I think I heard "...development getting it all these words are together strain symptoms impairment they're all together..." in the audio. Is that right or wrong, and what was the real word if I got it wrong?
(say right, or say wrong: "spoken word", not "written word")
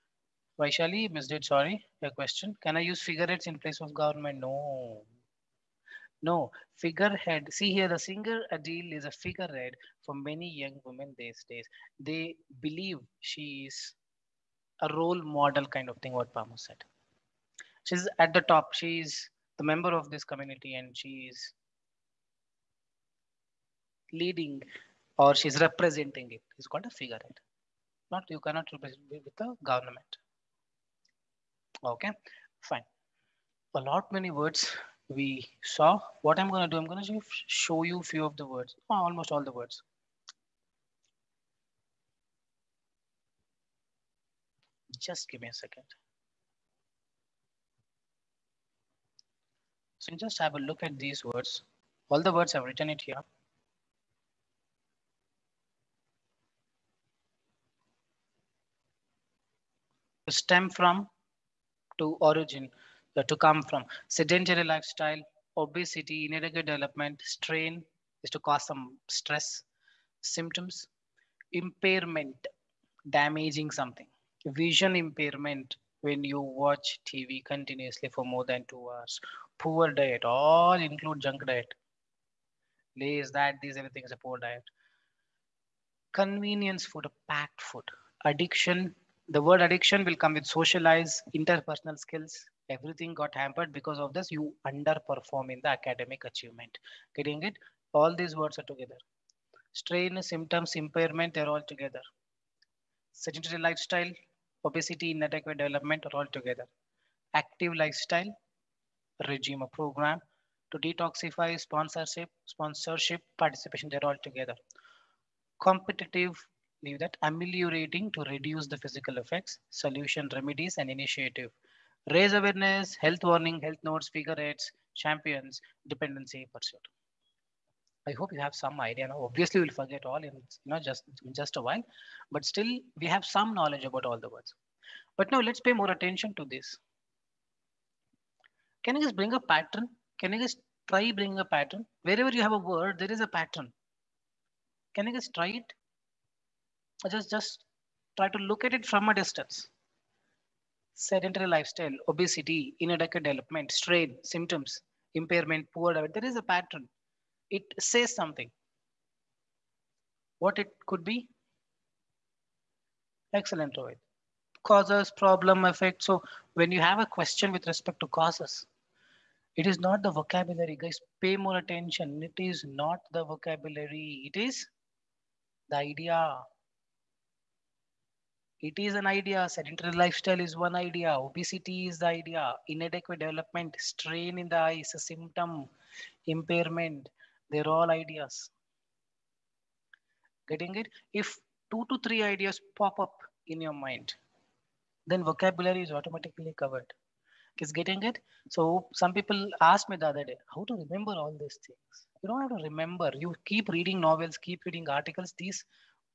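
wrong: "achievement", not "development".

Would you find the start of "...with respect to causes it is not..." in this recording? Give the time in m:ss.
2:47.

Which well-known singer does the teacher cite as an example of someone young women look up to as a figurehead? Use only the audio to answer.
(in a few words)
Adele.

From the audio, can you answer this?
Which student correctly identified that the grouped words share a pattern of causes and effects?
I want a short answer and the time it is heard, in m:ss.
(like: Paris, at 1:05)
Rohit, at 2:43.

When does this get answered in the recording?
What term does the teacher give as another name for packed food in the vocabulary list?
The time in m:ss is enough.
1:26.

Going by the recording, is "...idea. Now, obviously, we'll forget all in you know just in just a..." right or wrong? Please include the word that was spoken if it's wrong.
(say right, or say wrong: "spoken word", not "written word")
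right.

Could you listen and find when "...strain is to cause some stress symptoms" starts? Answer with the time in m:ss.
1:07.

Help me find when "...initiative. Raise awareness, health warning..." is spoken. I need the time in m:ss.
2:00.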